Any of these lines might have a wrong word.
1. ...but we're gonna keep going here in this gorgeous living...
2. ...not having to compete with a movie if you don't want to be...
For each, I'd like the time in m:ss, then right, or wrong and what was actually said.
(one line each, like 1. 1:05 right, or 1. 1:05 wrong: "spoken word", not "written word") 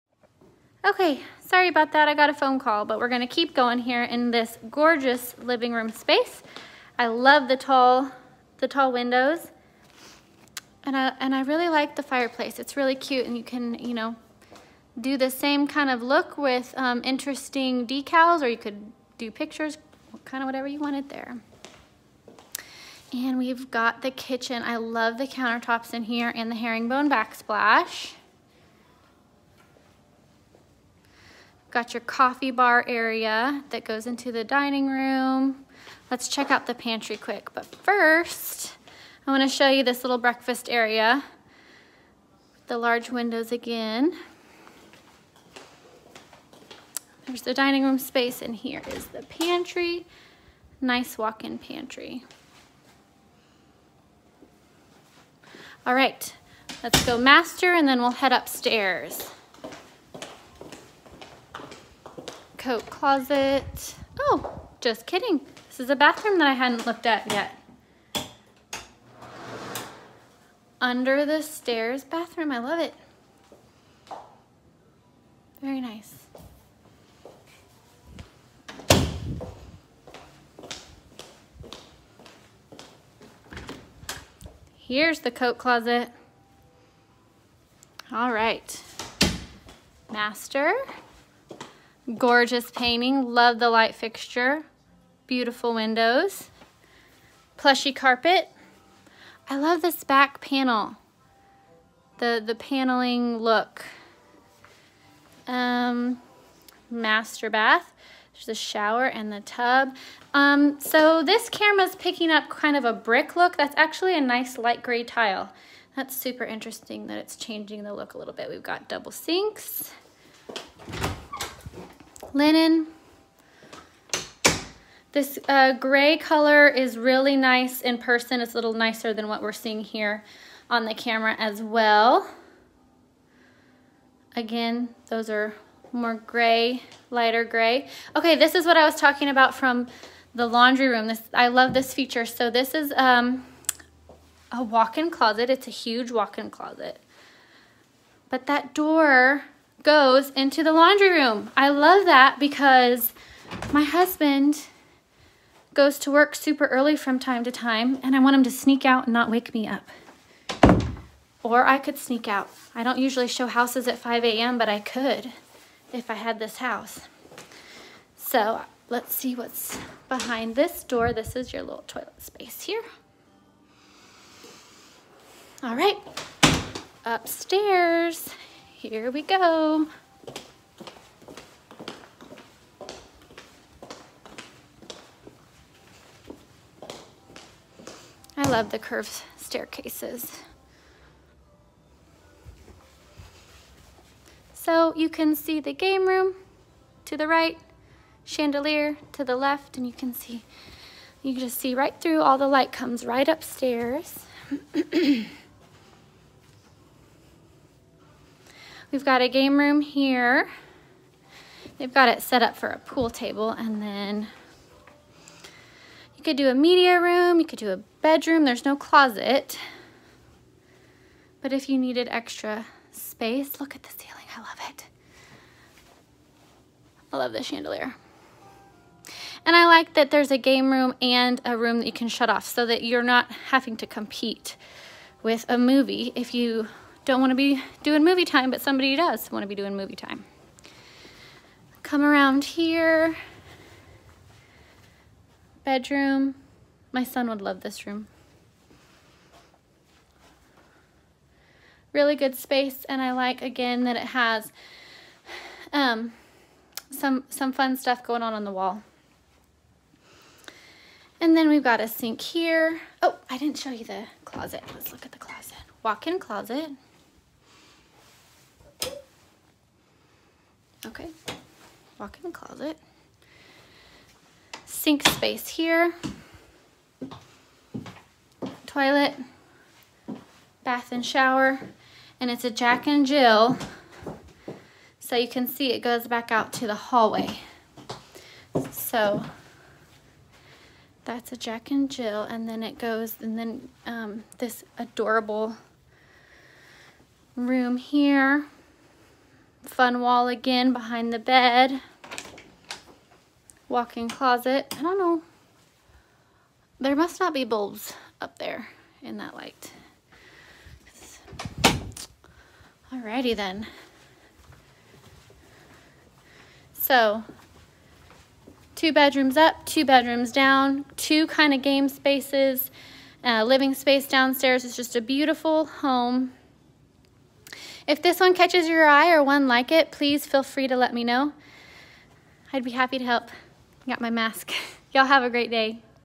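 1. 0:02 right
2. 3:53 right.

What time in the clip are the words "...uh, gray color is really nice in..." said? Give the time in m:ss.
2:05.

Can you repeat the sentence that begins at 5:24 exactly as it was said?
It's just a beautiful home if this one catches your eye or one like it, please feel free to let me know.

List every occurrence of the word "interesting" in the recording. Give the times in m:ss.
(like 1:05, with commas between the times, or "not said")
0:17, 1:56.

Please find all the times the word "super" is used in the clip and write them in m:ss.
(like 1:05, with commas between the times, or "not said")
1:56, 2:36.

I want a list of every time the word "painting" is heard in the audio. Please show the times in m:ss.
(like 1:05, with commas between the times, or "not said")
1:32.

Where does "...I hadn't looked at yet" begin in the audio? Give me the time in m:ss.
1:06.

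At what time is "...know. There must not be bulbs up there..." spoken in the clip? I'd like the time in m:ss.
5:04.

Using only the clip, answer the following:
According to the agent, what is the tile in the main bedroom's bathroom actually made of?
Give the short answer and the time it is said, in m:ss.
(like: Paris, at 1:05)
Light gray tile, at 1:54.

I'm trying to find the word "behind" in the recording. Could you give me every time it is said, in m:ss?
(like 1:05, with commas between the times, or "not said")
2:50, 5:00.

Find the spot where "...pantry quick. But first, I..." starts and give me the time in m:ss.
0:36.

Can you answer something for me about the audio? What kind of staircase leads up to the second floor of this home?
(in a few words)
Curved.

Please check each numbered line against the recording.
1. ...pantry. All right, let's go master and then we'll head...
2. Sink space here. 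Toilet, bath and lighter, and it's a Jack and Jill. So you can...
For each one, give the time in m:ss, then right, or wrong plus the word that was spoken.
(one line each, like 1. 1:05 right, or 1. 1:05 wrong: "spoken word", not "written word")
1. 0:51 right
2. 4:34 wrong: "shower", not "lighter".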